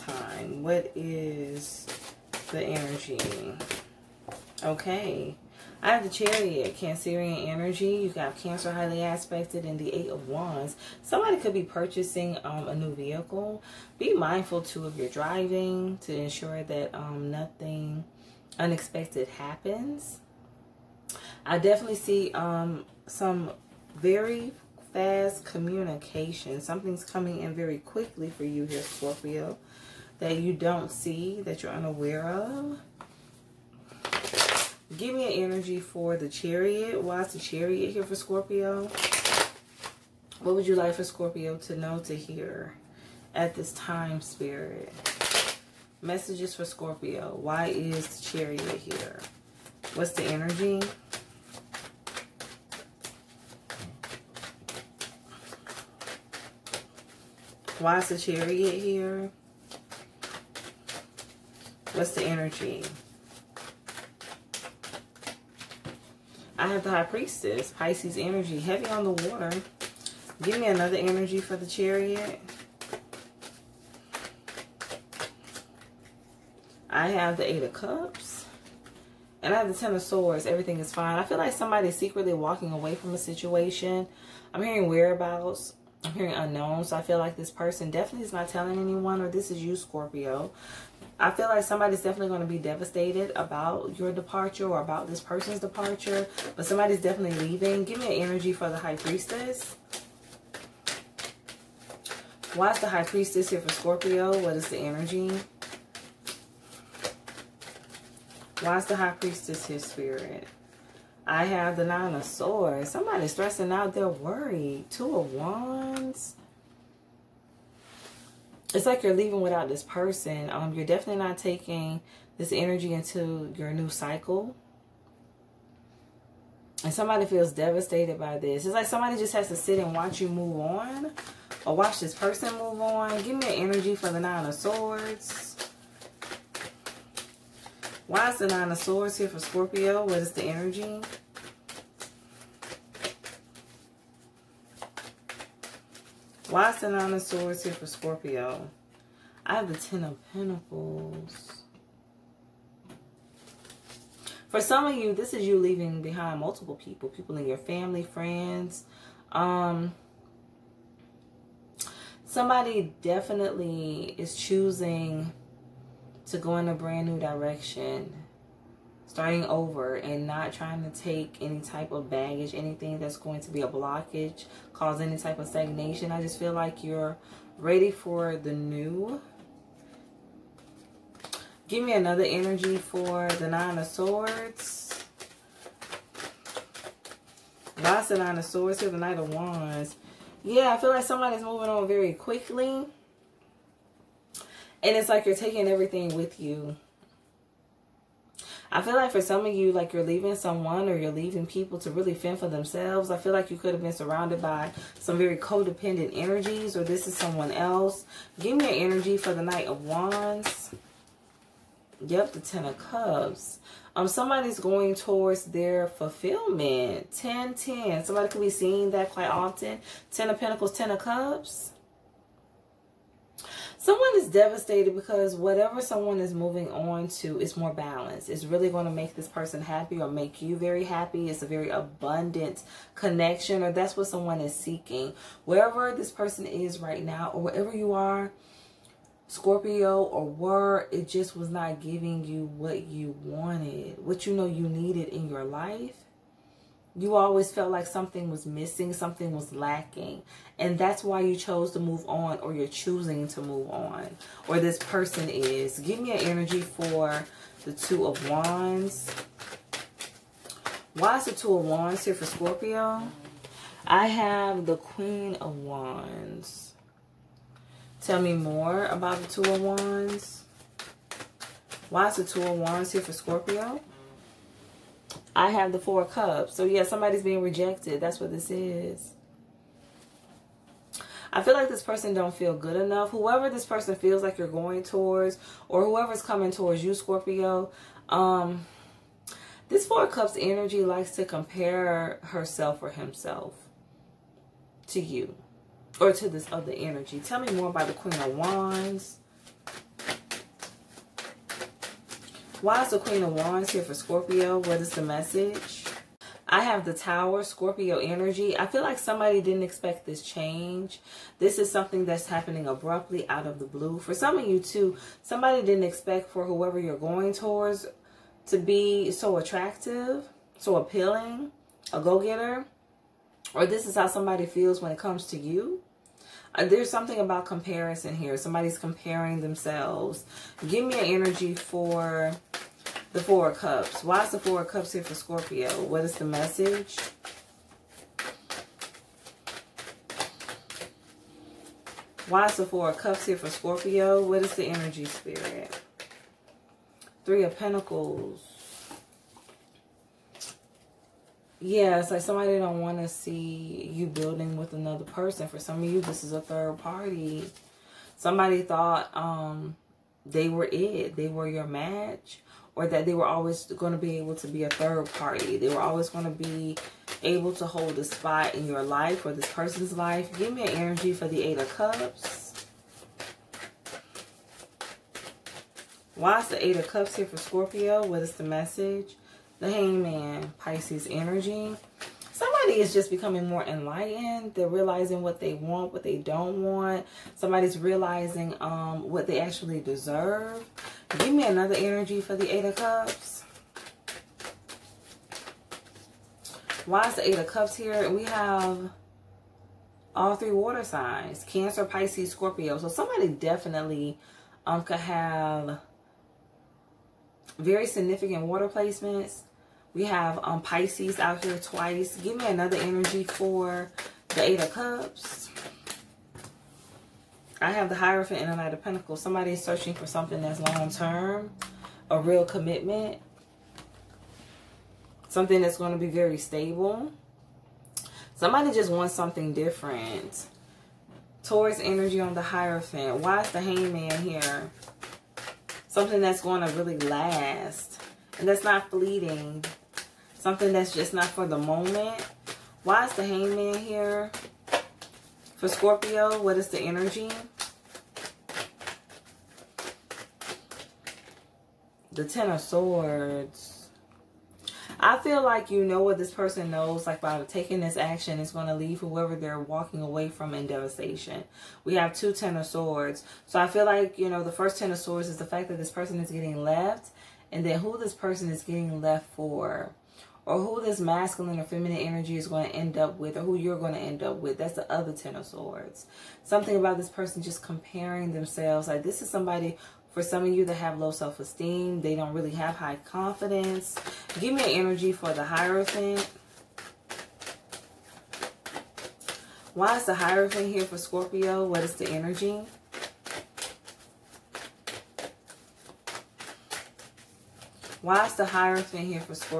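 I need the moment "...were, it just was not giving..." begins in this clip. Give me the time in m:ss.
4:00.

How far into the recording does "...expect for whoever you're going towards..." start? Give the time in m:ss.
5:15.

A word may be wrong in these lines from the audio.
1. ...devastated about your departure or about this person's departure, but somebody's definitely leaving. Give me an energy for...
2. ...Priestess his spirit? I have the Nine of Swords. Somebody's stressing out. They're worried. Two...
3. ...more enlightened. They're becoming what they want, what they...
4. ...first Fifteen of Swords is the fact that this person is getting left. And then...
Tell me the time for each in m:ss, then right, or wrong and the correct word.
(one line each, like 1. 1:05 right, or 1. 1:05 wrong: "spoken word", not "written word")
1. 1:32 right
2. 1:49 right
3. 6:23 wrong: "realizing", not "becoming"
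4. 7:44 wrong: "Ten", not "Fifteen".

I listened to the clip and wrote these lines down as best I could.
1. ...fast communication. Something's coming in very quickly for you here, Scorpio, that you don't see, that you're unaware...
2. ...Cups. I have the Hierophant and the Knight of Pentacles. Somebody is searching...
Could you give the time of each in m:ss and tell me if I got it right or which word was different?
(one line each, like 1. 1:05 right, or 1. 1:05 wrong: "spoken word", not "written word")
1. 0:24 right
2. 6:54 right.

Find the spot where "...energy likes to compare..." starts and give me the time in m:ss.
4:50.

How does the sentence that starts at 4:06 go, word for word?
You always felt like something was missing, something was lacking.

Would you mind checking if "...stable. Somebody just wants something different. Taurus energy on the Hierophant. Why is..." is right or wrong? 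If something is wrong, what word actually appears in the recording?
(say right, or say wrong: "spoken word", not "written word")
right.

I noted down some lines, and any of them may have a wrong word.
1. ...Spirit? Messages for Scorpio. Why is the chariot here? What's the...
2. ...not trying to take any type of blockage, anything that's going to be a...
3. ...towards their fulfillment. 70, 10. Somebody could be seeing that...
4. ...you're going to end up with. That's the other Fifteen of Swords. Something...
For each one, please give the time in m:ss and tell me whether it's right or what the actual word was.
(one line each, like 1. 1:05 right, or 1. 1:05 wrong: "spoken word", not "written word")
1. 0:44 right
2. 2:50 wrong: "baggage", not "blockage"
3. 3:34 wrong: "10", not "70"
4. 7:53 wrong: "Ten", not "Fifteen".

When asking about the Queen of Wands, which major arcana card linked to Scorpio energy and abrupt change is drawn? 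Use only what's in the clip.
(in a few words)
The Tower.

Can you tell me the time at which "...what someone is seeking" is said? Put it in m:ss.
3:53.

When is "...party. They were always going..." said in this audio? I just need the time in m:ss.
6:05.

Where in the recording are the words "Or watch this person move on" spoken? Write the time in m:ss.
2:11.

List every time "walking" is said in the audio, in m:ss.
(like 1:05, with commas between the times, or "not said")
1:22, 7:39.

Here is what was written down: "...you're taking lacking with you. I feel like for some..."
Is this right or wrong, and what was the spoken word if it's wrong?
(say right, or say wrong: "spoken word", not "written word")
wrong: "everything", not "lacking".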